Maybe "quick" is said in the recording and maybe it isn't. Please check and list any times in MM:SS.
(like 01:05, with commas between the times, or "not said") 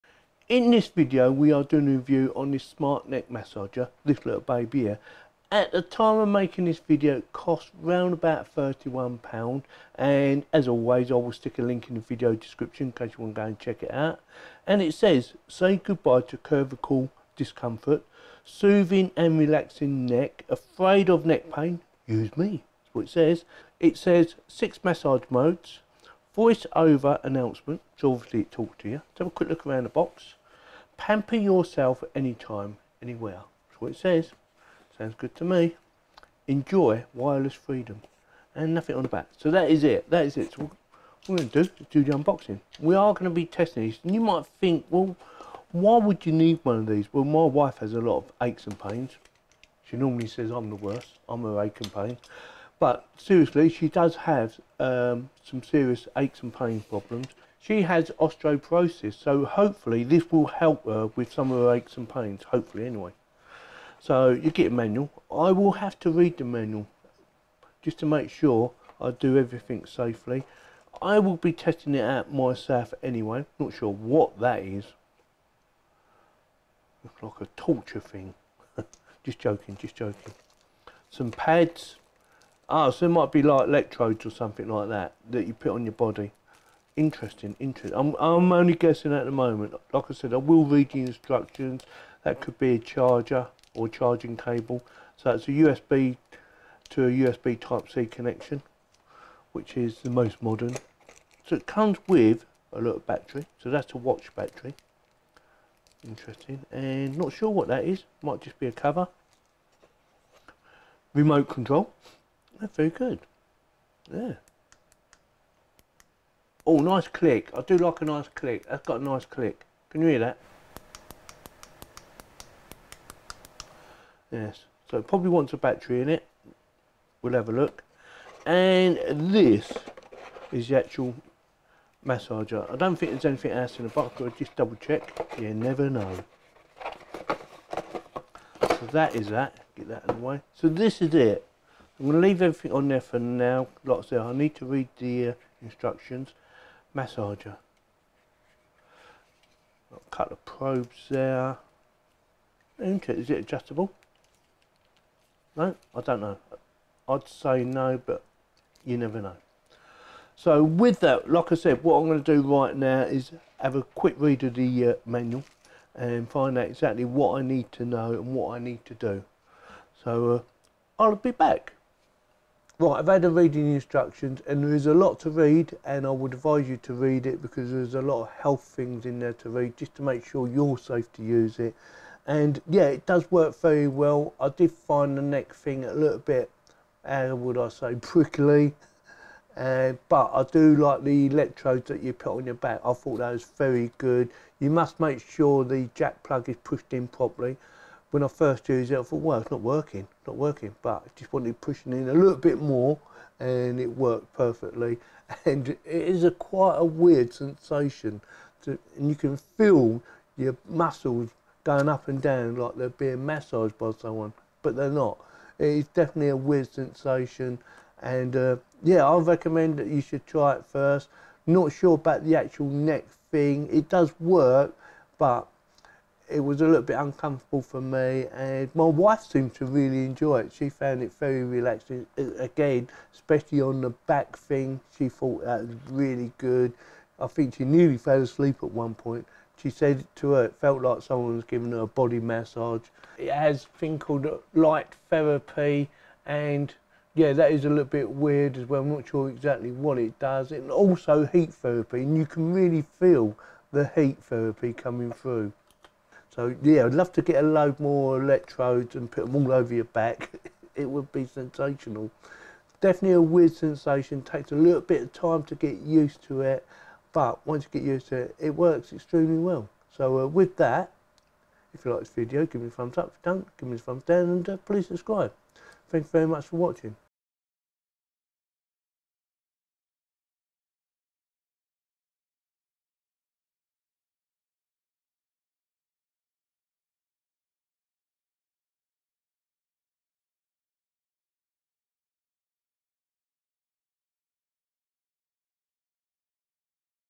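00:29, 02:43.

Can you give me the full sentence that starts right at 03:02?
And yeah, it does work very well.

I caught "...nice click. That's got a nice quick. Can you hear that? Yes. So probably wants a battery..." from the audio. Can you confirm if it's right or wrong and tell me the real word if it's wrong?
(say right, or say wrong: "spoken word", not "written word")
wrong: "click", not "quick".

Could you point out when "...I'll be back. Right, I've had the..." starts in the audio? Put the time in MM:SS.
02:51.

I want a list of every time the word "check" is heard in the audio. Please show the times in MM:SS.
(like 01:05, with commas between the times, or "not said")
00:13, 02:14.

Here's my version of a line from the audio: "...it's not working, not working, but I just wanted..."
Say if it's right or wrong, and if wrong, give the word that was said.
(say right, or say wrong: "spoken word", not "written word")
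right.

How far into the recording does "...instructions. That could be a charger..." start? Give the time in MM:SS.
01:31.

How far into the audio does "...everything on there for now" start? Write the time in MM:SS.
02:22.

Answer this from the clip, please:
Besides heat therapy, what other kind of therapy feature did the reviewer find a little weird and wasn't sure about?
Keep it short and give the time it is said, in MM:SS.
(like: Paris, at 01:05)
light therapy, at 04:04.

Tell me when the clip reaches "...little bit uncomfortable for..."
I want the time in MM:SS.
03:46.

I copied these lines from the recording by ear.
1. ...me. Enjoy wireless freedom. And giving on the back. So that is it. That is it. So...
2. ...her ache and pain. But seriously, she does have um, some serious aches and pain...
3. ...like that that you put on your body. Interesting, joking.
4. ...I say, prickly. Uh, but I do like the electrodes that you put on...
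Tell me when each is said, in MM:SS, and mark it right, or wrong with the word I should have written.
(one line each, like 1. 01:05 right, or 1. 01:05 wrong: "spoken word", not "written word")
1. 00:35 wrong: "nothing", not "giving"
2. 00:51 right
3. 01:24 wrong: "interesting", not "joking"
4. 03:07 right.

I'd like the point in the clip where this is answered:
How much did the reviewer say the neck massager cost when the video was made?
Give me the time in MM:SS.
00:08.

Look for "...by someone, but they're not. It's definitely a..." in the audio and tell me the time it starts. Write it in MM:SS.
03:33.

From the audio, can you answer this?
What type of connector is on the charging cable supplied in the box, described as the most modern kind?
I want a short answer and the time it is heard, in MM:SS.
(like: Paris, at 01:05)
USB Type-C, at 01:37.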